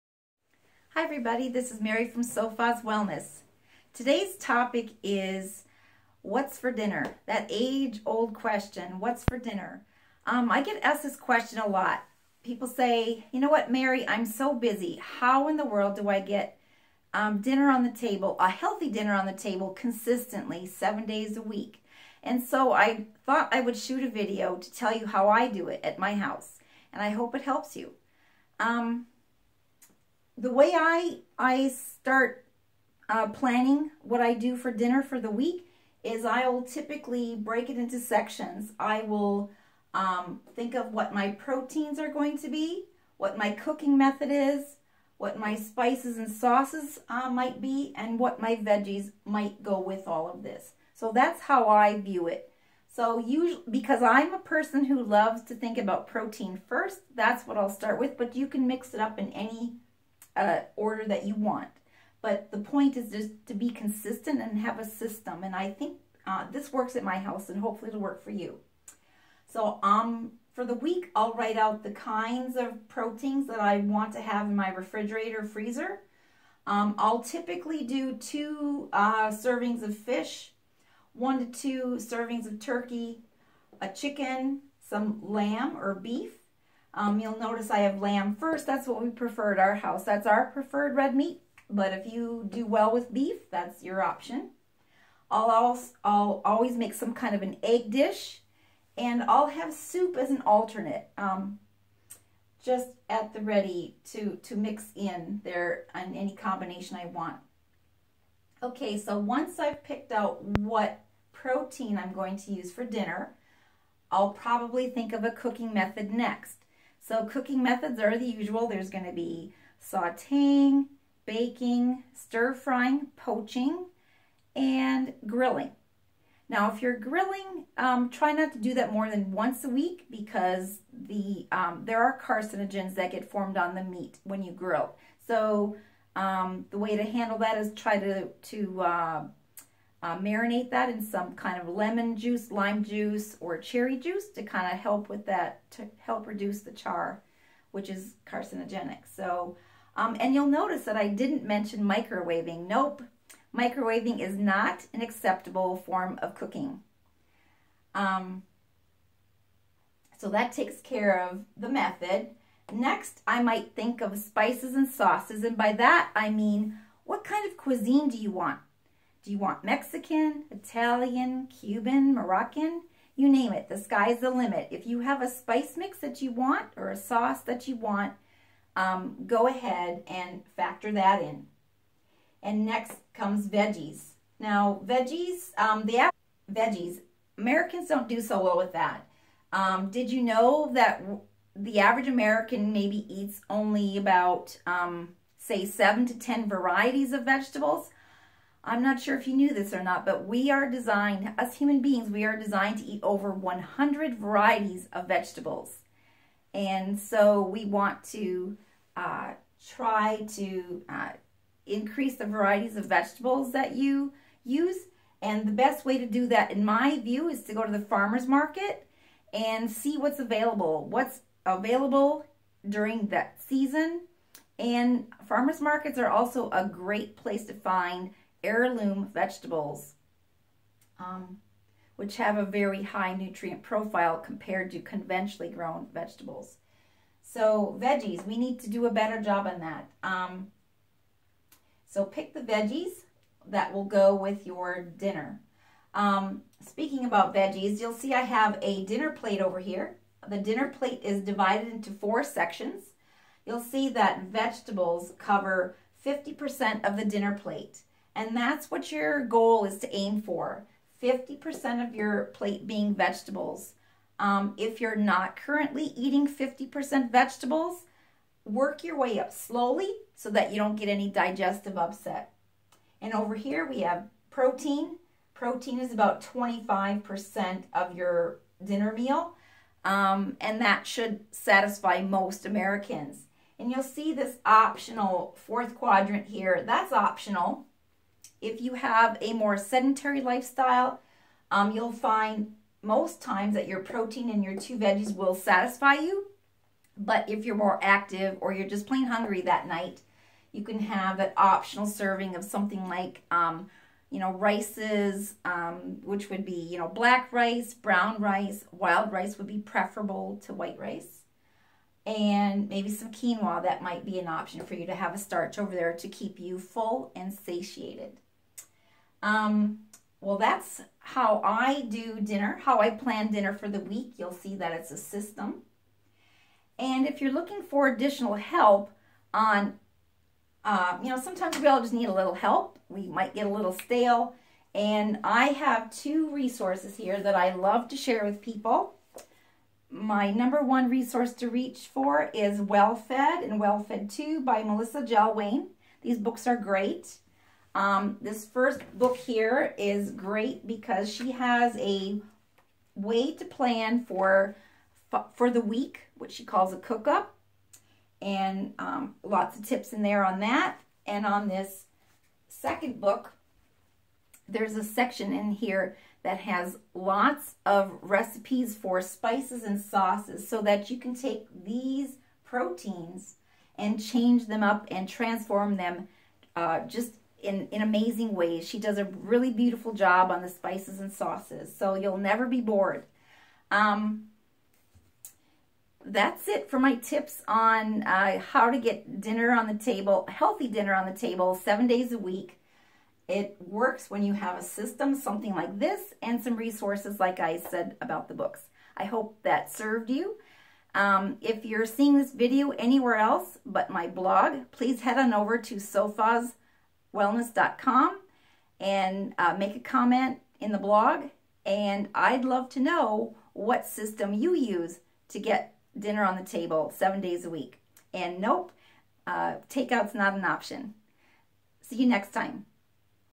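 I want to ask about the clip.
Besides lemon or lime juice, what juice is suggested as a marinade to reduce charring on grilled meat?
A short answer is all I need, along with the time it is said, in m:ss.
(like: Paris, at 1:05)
Cherry juice, at 2:23.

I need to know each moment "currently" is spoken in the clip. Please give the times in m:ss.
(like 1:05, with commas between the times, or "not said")
4:25.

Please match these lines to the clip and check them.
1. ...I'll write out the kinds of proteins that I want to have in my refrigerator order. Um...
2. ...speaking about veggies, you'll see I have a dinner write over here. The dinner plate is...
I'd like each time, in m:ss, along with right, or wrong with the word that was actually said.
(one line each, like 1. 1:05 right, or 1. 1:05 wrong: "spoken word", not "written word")
1. 1:11 wrong: "freezer", not "order"
2. 4:06 wrong: "plate", not "write".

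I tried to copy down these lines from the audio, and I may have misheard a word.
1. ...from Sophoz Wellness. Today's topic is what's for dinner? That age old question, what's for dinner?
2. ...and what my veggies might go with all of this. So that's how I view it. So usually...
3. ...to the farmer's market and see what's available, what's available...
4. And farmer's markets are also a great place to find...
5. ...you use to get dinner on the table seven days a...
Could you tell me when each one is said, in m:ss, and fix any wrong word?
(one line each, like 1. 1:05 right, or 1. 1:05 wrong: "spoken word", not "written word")
1. 0:02 right
2. 0:47 right
3. 3:37 right
4. 3:44 right
5. 6:54 right.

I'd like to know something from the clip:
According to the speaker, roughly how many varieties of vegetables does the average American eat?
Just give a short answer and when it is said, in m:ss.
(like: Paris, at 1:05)
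7 to 10, at 3:15.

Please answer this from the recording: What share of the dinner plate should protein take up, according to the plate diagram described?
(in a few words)
25%.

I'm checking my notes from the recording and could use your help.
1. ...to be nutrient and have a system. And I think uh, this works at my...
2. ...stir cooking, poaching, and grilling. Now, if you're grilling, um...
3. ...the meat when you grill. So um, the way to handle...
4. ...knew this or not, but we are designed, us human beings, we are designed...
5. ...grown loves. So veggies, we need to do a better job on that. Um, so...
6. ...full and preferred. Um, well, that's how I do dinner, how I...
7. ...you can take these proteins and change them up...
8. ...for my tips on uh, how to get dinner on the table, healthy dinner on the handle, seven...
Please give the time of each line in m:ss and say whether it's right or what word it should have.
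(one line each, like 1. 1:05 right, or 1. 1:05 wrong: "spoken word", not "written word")
1. 1:03 wrong: "consistent", not "nutrient"
2. 2:02 wrong: "frying", not "cooking"
3. 2:13 right
4. 3:19 right
5. 3:55 wrong: "vegetables", not "loves"
6. 5:16 wrong: "satiated", not "preferred"
7. 6:10 right
8. 6:26 wrong: "table", not "handle".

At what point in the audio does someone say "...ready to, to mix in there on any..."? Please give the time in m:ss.
1:43.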